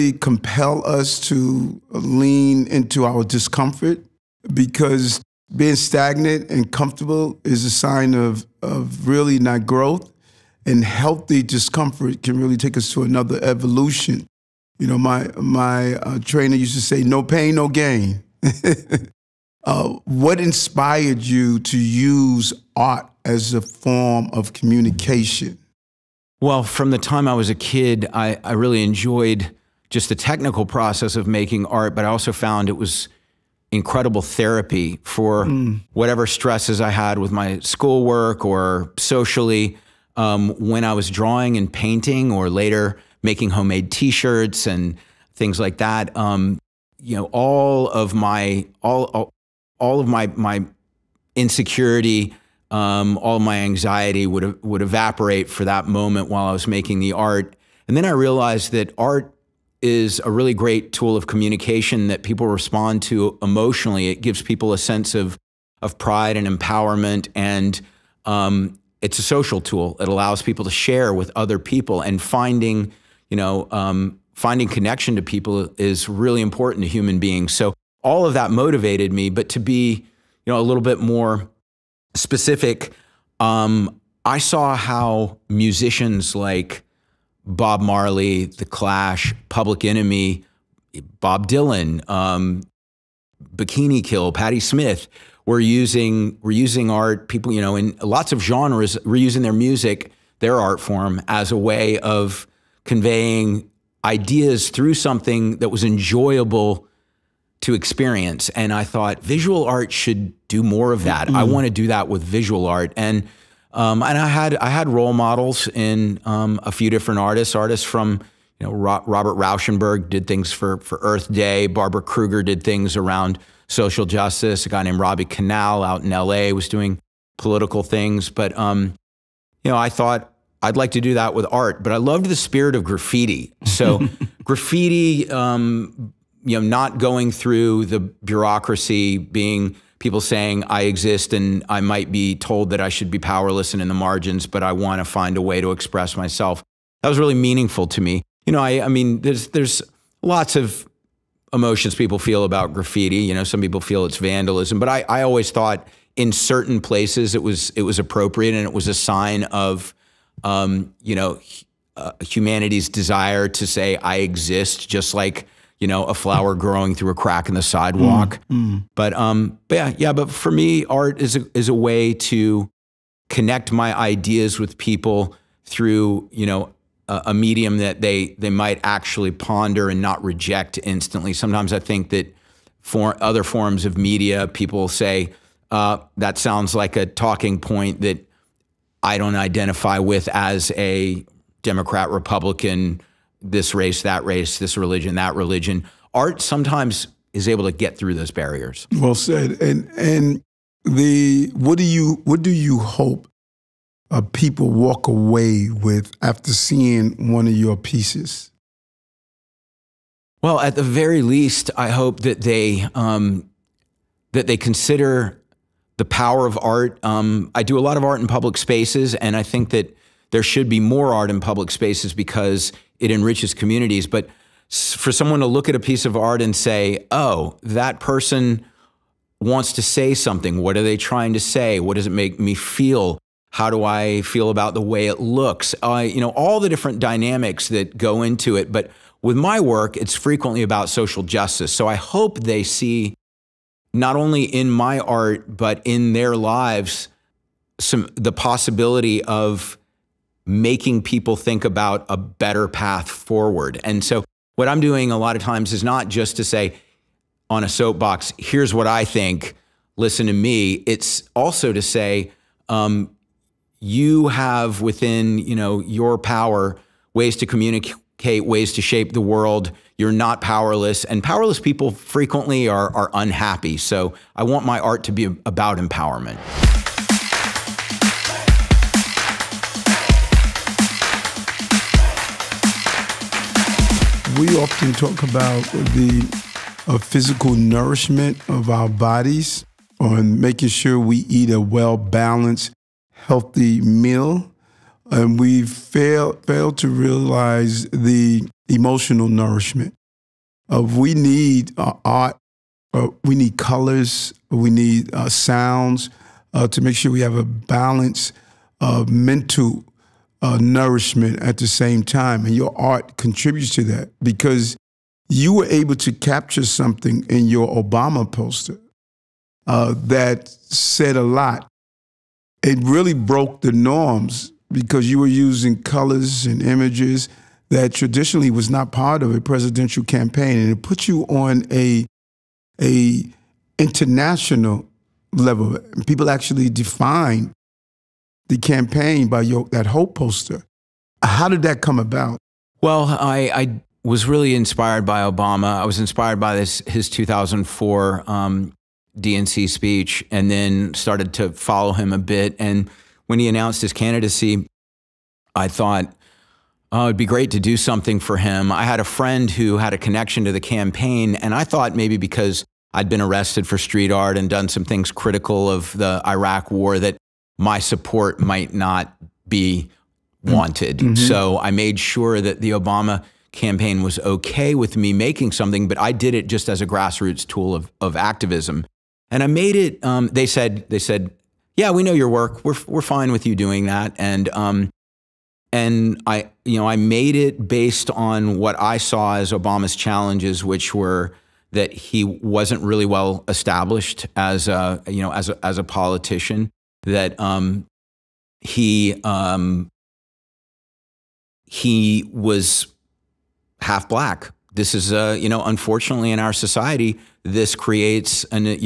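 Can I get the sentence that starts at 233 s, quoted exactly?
How do I feel about the way it looks?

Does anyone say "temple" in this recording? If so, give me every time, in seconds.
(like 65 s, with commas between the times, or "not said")
not said.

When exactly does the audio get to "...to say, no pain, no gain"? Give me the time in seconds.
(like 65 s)
16 s.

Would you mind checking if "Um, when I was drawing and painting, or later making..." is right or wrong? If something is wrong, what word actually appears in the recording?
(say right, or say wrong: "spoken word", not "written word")
right.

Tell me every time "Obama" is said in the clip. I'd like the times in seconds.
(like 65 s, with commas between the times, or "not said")
317 s, 345 s, 372 s, 389 s.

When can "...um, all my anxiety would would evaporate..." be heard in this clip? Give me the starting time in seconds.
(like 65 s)
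52 s.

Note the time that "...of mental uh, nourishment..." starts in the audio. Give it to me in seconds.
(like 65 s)
308 s.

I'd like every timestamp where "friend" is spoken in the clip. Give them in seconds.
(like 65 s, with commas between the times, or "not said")
359 s.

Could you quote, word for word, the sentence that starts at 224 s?
But for someone to look at a piece of art and say, oh, that person wants to say something.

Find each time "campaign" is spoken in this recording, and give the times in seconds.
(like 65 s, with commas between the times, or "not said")
330 s, 338 s, 360 s, 373 s.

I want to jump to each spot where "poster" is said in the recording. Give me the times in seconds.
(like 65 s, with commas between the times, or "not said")
318 s, 340 s.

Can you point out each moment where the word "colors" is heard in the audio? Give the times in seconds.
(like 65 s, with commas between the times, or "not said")
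303 s, 325 s.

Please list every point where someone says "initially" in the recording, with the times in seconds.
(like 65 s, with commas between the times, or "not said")
not said.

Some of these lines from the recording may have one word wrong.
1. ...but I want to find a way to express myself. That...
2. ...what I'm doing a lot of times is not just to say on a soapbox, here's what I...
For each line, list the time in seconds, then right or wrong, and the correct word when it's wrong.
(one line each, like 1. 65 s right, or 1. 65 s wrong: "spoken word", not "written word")
1. 144 s right
2. 254 s right.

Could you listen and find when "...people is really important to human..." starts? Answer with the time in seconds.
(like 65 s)
75 s.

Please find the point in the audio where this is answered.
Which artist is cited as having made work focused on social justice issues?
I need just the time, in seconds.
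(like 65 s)
121 s.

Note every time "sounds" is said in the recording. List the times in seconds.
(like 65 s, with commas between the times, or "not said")
186 s, 305 s.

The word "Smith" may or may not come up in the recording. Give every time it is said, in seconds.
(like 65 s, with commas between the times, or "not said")
94 s.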